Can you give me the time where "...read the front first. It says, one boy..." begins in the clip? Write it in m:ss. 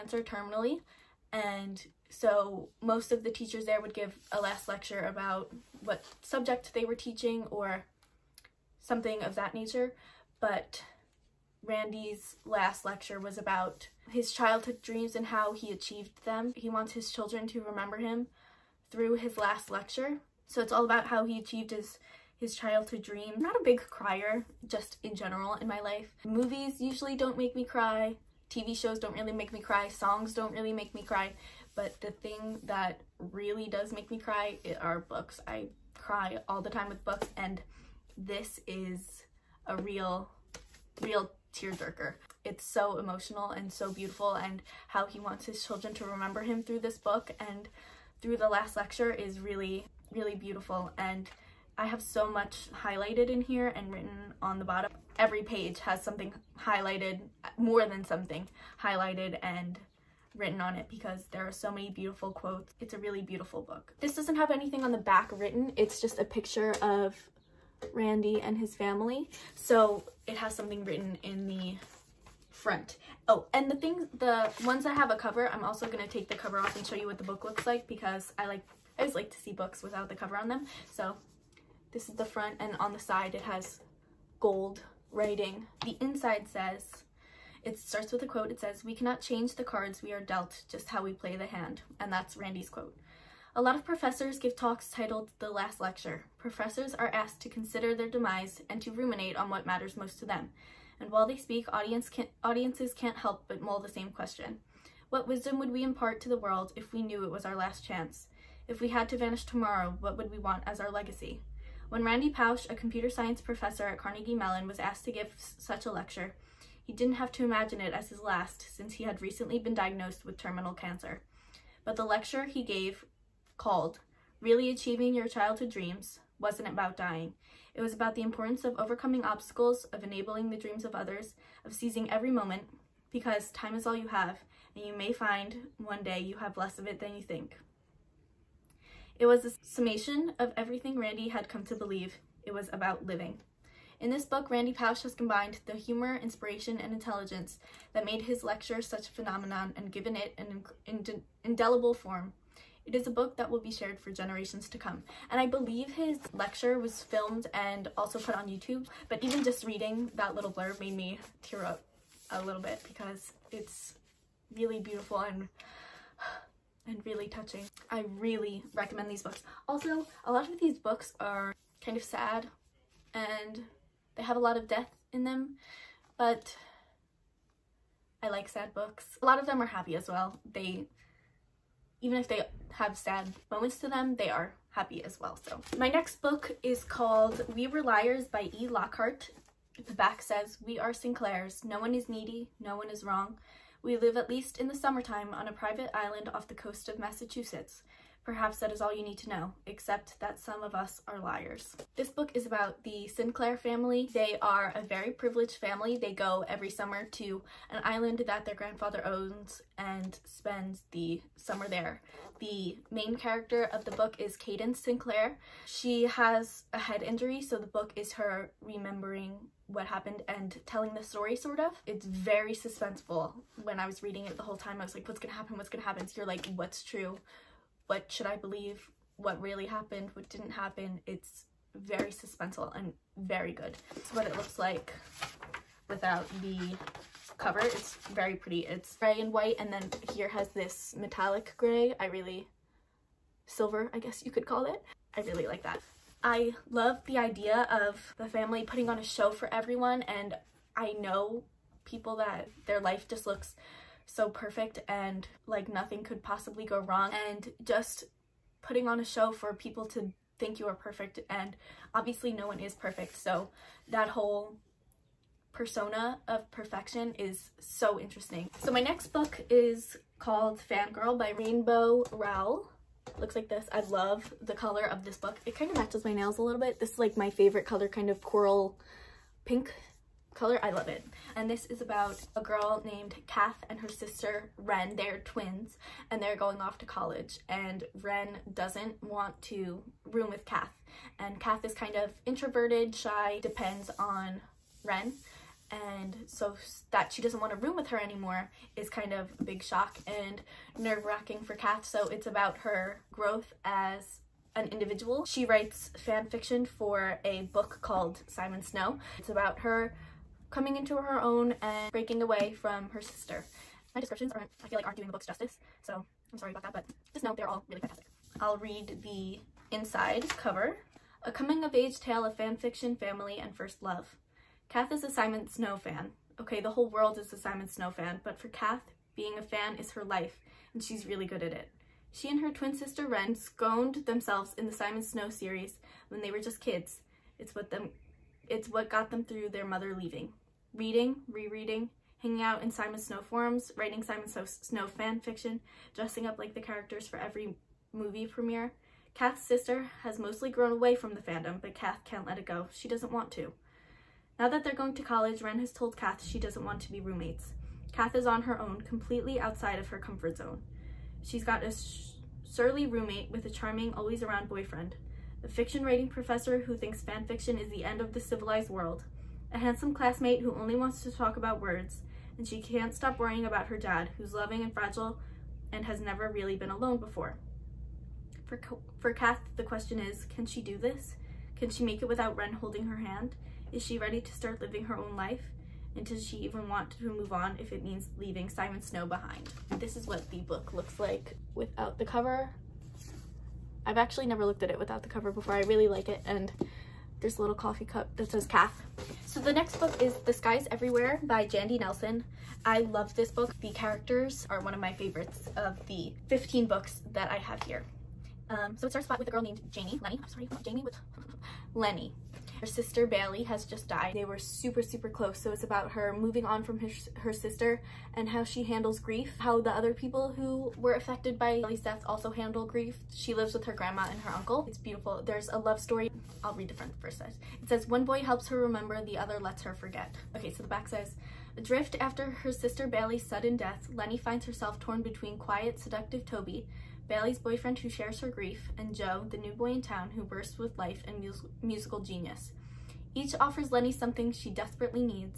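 7:06.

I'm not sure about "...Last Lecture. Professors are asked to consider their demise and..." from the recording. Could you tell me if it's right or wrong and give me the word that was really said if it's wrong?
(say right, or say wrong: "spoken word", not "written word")
right.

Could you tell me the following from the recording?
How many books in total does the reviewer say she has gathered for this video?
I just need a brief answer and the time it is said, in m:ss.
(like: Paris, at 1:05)
15, at 6:46.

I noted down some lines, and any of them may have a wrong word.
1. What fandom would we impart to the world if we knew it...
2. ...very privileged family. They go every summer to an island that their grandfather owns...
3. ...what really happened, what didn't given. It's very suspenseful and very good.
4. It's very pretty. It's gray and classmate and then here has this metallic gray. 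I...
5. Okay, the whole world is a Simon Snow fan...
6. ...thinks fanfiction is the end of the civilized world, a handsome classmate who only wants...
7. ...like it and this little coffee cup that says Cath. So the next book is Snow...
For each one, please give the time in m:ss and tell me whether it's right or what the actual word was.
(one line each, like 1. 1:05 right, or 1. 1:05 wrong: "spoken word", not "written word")
1. 1:45 wrong: "wisdom", not "fandom"
2. 3:24 right
3. 3:49 wrong: "happen", not "given"
4. 3:57 wrong: "white", not "classmate"
5. 5:26 right
6. 6:06 right
7. 6:35 wrong: "The", not "Snow".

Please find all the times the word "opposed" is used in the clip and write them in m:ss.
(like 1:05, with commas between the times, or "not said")
not said.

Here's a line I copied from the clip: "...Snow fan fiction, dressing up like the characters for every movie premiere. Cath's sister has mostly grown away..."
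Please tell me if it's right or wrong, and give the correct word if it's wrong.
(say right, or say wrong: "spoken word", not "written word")
right.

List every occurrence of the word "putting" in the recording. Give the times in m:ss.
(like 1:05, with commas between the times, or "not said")
4:08, 4:18.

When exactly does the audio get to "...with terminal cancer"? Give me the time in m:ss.
2:00.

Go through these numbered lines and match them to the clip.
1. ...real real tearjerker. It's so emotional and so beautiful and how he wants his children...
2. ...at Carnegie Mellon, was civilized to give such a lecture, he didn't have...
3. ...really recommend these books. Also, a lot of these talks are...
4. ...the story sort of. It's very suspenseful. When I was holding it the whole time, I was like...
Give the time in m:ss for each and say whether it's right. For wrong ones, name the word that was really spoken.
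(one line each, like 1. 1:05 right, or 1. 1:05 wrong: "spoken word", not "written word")
1. 0:39 right
2. 1:53 wrong: "asked", not "civilized"
3. 2:48 wrong: "books", not "talks"
4. 3:40 wrong: "reading", not "holding".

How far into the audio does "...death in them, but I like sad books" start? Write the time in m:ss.
2:54.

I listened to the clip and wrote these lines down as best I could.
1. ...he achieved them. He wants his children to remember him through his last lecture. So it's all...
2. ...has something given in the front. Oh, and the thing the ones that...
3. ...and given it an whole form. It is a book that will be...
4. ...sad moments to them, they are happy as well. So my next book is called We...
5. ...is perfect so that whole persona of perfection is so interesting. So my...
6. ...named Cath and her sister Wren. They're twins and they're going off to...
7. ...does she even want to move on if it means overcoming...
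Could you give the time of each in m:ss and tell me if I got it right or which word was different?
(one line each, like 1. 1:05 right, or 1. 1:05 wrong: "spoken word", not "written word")
1. 0:15 right
2. 1:10 wrong: "written", not "given"
3. 2:29 wrong: "indelible", not "whole"
4. 3:02 right
5. 4:22 right
6. 4:42 right
7. 6:26 wrong: "leaving", not "overcoming".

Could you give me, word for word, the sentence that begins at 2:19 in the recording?
It was a summation of everything Randy had come to believe.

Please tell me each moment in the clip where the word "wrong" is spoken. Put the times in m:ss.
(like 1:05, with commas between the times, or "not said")
3:13, 4:16.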